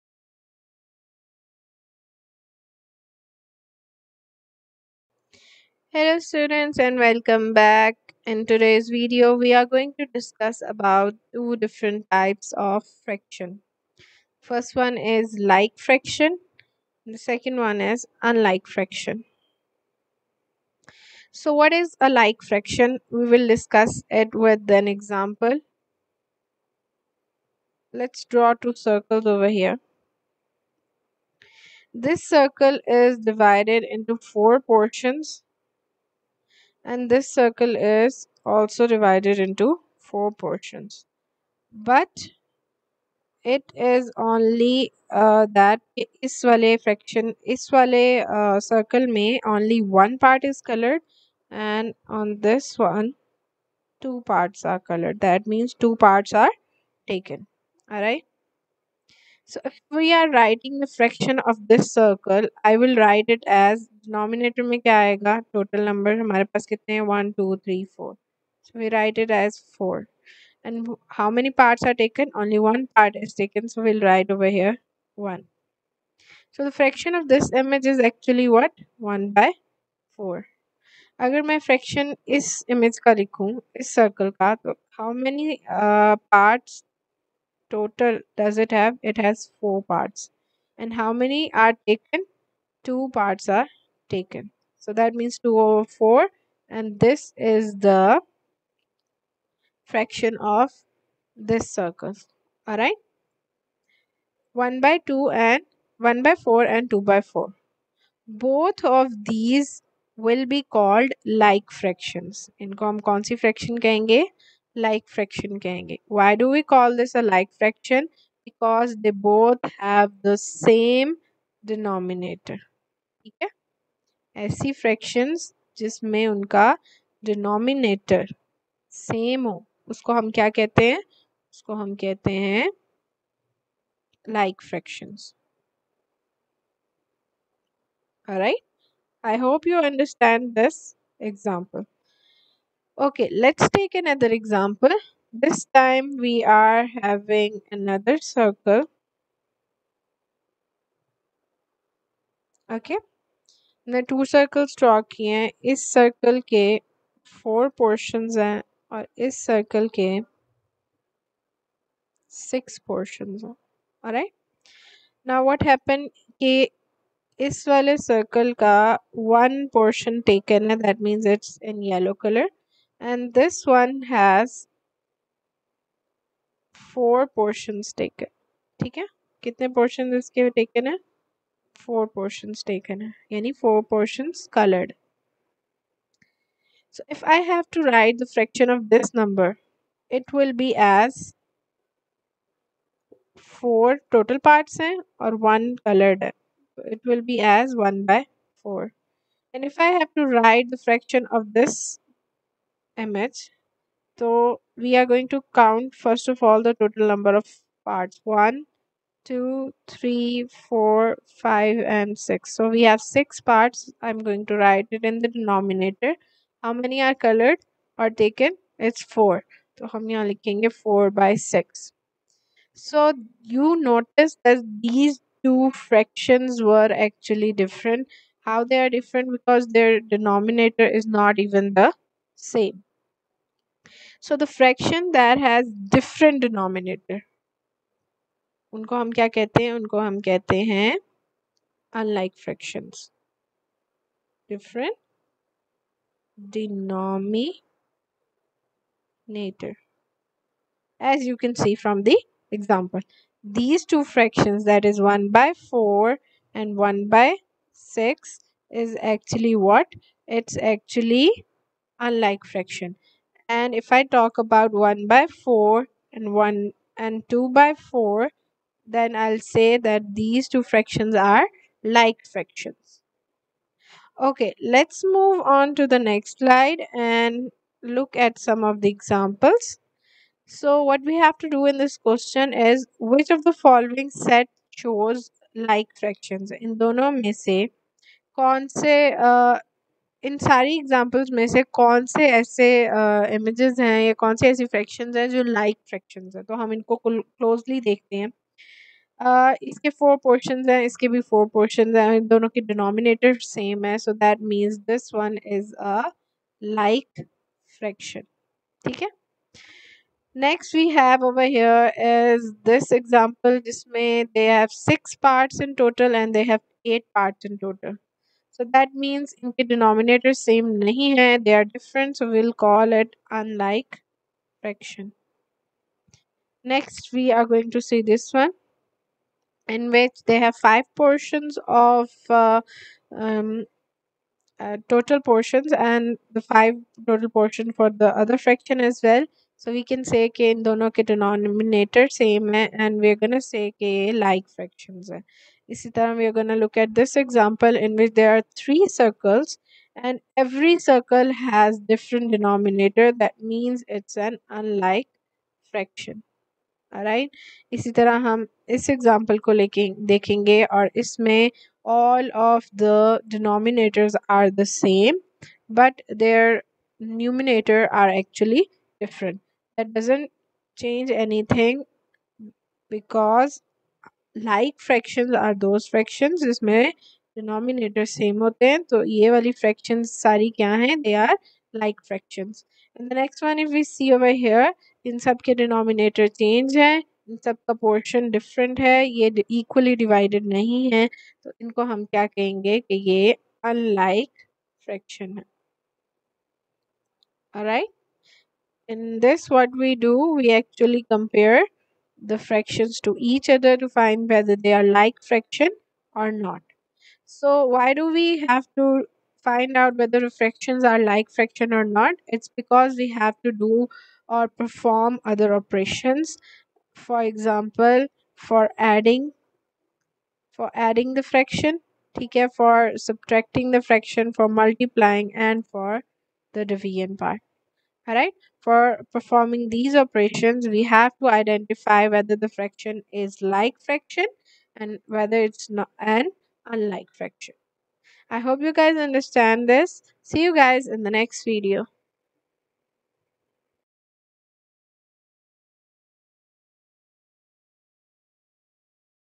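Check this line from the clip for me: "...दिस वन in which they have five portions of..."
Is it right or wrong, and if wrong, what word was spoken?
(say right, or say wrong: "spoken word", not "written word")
right.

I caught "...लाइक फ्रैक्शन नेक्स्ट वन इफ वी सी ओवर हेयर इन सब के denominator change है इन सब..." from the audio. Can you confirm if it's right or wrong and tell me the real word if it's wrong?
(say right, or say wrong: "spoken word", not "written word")
right.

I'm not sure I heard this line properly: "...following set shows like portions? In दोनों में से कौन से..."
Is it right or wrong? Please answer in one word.
wrong.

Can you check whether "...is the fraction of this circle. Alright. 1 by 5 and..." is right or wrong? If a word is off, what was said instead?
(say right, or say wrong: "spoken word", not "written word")
wrong: "2", not "5".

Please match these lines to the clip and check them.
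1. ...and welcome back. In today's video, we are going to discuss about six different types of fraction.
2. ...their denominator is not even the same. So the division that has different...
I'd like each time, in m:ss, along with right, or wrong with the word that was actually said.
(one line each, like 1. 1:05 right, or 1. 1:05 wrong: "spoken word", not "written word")
1. 0:06 wrong: "two", not "six"
2. 3:49 wrong: "fraction", not "division".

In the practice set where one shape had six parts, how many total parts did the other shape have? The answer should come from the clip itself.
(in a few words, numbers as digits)
8.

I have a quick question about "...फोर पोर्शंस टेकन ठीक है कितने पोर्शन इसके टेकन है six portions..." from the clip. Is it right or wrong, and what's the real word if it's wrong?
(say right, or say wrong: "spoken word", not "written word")
wrong: "four", not "six".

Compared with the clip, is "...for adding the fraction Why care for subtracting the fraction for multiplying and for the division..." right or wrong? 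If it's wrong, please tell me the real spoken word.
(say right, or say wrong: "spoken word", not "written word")
wrong: "Take", not "Why".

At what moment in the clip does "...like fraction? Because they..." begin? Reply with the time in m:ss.
1:57.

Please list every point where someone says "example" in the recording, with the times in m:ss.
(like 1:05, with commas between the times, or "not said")
0:24, 4:12, 4:38, 4:50, 5:47, 6:57.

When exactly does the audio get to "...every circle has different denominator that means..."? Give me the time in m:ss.
5:50.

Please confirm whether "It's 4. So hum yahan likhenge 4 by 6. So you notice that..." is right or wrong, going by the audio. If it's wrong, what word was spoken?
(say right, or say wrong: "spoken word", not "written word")
right.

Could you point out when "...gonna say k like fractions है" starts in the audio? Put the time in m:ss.
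5:43.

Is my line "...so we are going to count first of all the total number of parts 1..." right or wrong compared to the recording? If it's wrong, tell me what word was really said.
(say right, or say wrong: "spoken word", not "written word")
right.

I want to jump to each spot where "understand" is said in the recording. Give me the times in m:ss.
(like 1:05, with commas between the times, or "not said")
7:18.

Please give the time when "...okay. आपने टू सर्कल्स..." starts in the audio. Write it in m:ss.
2:32.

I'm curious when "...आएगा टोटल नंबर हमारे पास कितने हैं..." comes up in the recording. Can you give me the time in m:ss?
1:04.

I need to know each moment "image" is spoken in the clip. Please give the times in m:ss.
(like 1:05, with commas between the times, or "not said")
1:17, 3:23.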